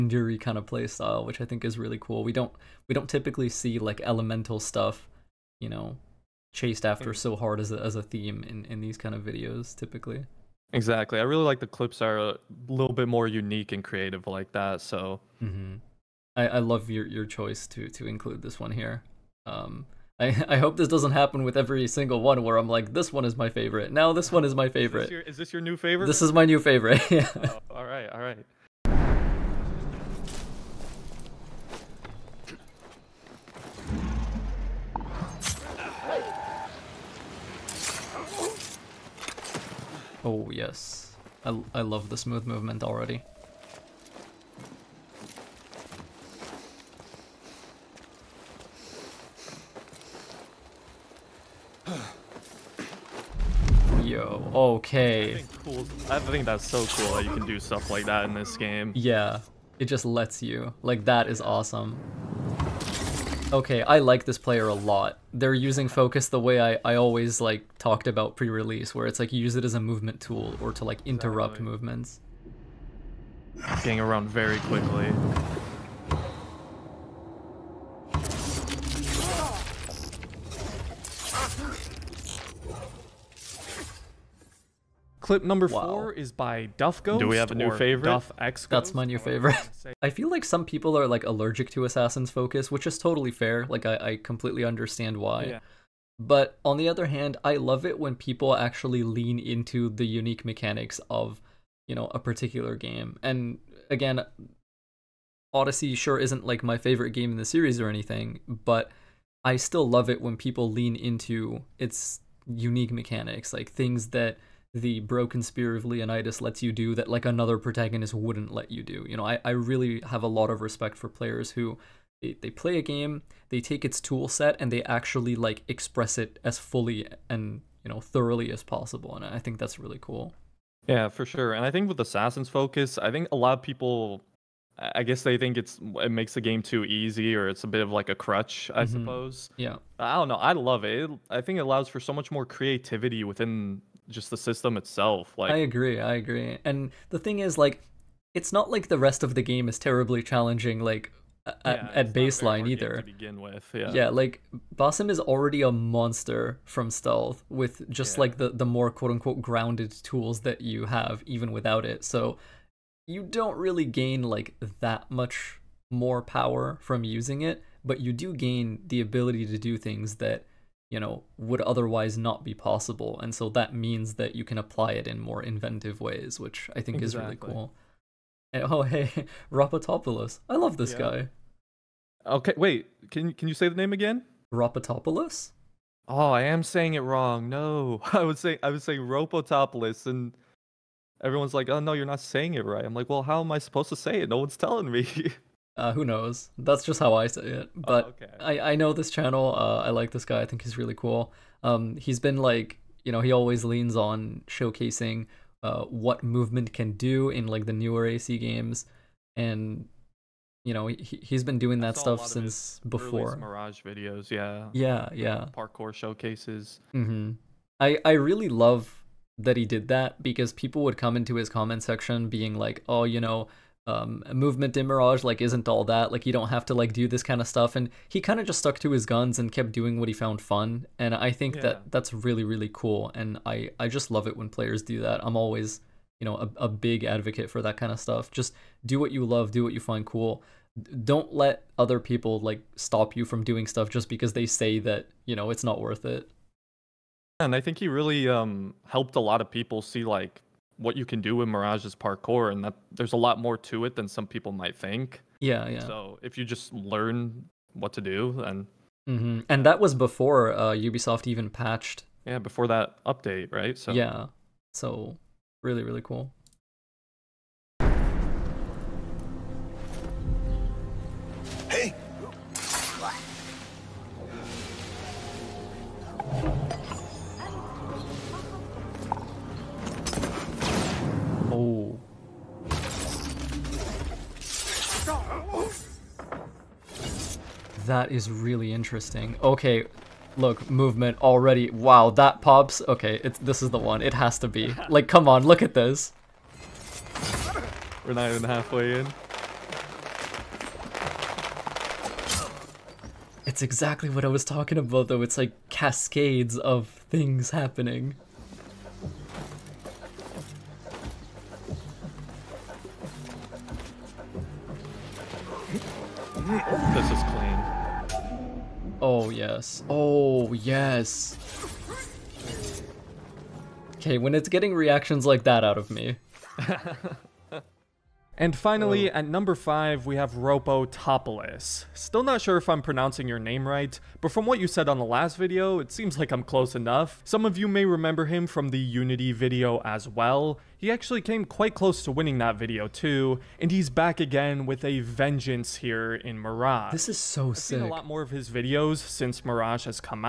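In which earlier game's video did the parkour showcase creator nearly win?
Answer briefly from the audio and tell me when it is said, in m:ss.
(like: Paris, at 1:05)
Unity, at 5:38.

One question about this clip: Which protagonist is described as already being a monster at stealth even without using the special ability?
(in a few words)
Basim.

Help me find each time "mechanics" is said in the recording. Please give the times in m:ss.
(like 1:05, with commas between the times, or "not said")
1:40, 1:52.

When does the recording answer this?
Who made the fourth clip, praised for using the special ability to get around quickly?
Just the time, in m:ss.
1:26.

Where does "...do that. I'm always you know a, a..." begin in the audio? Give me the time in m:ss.
3:54.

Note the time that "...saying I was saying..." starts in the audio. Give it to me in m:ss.
3:08.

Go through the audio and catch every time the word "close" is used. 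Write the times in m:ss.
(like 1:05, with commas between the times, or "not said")
5:36, 5:41.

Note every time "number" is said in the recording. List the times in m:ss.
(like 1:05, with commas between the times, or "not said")
1:25, 5:29.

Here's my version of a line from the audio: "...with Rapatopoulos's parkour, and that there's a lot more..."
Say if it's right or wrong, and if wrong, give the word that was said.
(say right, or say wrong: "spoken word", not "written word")
wrong: "Mirage", not "Rapatopoulos".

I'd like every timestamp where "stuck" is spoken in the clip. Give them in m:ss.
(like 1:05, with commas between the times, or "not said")
3:48.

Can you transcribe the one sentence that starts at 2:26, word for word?
And the thing is, like, it's not like the rest of the game is terribly challenging.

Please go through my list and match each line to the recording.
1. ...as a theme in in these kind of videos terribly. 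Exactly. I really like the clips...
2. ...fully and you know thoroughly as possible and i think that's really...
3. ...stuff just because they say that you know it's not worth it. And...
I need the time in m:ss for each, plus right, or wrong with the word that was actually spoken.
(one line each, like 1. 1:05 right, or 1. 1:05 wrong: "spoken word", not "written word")
1. 0:07 wrong: "typically", not "terribly"
2. 2:06 right
3. 4:03 right.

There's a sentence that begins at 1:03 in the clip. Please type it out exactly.
Okay, I like this player a lot.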